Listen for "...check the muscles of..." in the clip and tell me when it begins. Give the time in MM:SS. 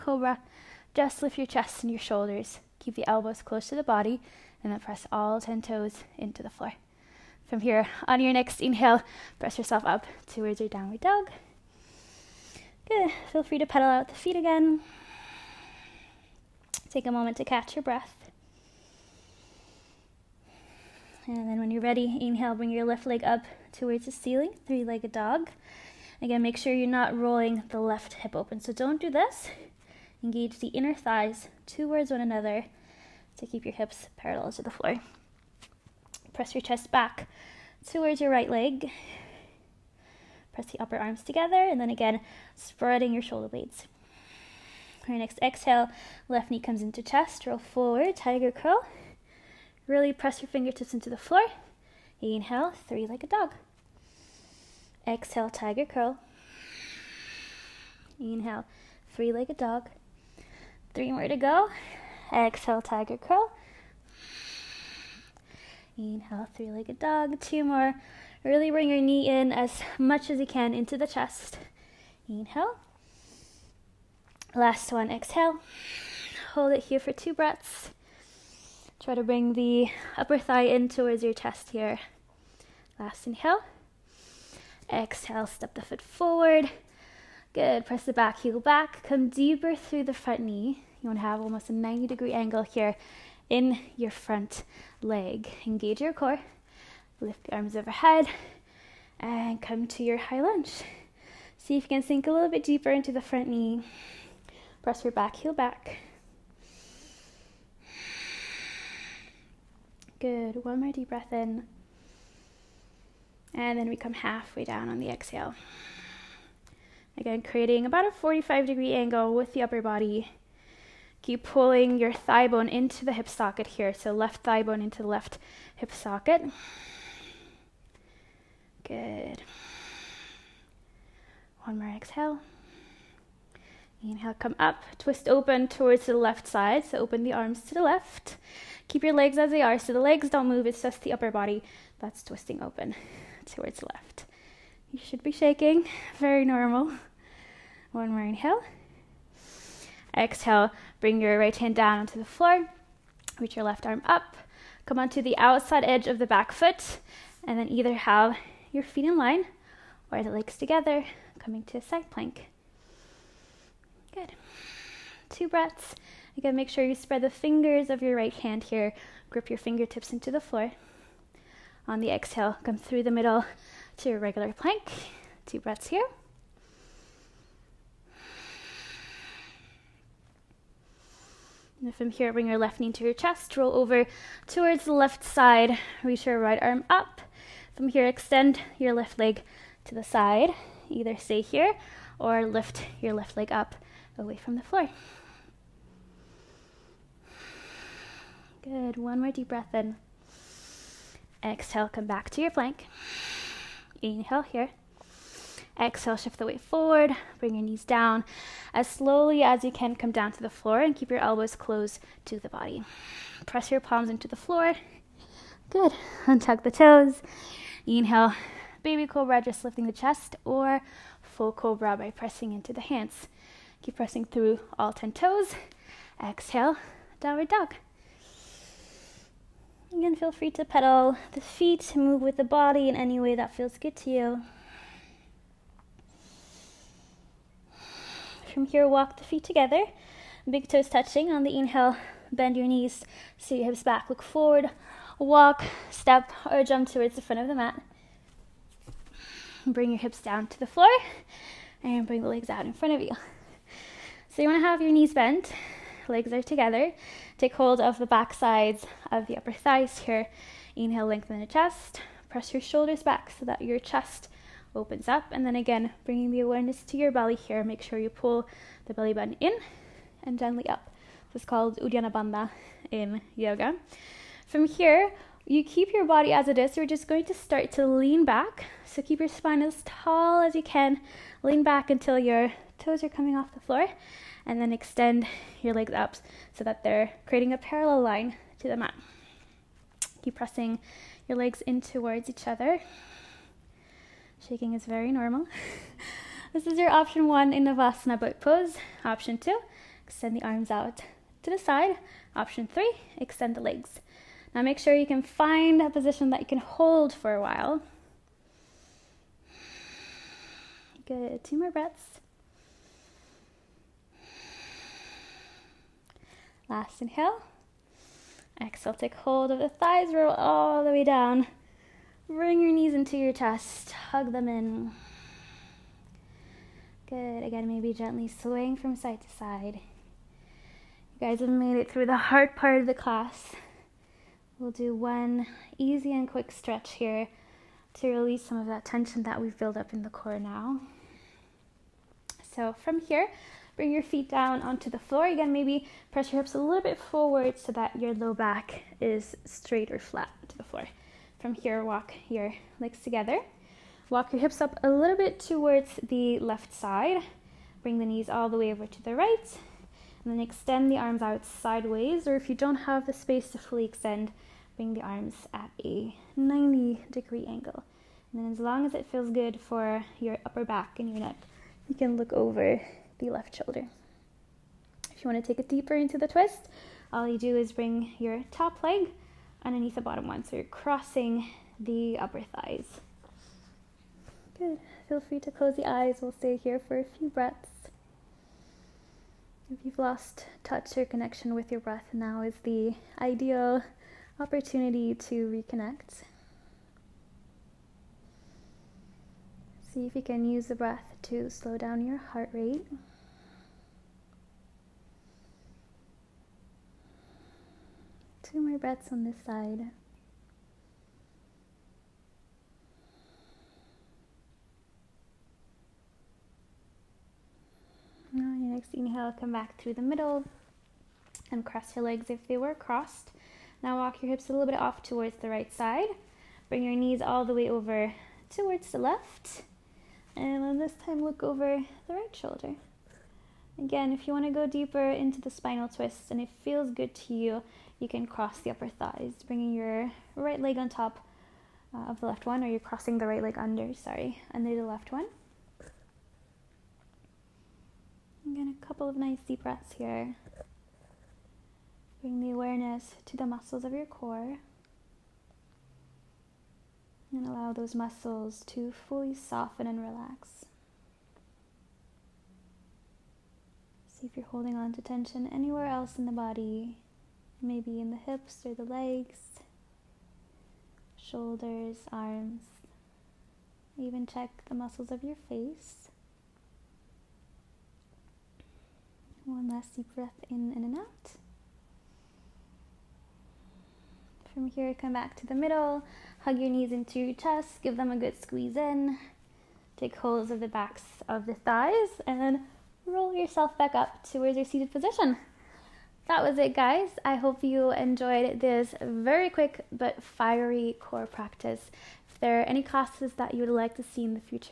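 07:54.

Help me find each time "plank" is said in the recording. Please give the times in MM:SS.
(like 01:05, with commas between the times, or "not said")
02:42, 02:54, 03:22.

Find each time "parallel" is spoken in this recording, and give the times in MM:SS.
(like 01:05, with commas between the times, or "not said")
00:34, 04:47.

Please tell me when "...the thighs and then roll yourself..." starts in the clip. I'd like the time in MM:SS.
08:11.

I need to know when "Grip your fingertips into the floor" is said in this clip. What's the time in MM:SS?
02:49.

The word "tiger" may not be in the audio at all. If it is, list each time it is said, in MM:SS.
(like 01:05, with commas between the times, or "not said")
00:48, 00:55, 01:02.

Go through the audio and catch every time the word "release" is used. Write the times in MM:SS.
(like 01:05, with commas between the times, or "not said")
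05:38.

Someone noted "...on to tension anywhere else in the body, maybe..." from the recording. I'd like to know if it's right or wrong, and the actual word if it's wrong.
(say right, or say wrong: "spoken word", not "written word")
right.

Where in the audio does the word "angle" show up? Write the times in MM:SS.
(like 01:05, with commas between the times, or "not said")
01:32, 01:58, 06:07.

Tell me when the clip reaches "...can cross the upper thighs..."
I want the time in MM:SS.
07:18.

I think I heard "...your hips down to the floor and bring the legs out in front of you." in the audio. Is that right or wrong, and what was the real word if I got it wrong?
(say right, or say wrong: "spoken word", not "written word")
right.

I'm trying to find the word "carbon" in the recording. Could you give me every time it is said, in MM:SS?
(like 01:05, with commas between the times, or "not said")
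not said.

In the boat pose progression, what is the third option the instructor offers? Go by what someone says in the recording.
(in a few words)
extend the legs.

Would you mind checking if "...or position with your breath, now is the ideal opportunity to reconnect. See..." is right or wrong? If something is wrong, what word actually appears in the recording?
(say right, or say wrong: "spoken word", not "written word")
wrong: "connection", not "position".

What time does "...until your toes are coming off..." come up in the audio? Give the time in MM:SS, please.
04:41.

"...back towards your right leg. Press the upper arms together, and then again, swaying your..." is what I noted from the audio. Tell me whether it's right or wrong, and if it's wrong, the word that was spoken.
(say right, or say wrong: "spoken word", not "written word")
wrong: "spreading", not "swaying".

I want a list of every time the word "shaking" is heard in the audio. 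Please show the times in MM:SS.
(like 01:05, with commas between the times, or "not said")
02:25, 04:54.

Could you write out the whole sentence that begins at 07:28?
in a couple of nice deep breaths here.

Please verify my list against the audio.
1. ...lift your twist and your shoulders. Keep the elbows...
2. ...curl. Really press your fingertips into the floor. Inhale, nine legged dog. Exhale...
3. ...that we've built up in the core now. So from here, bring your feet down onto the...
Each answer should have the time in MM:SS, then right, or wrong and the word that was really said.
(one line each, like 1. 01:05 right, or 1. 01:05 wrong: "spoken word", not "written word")
1. 00:01 wrong: "chest", not "twist"
2. 00:48 wrong: "three", not "nine"
3. 05:39 right.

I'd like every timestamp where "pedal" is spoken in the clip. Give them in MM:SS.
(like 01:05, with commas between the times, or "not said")
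00:13, 03:50.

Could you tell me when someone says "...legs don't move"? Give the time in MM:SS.
02:19.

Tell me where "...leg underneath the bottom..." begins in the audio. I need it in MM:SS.
06:18.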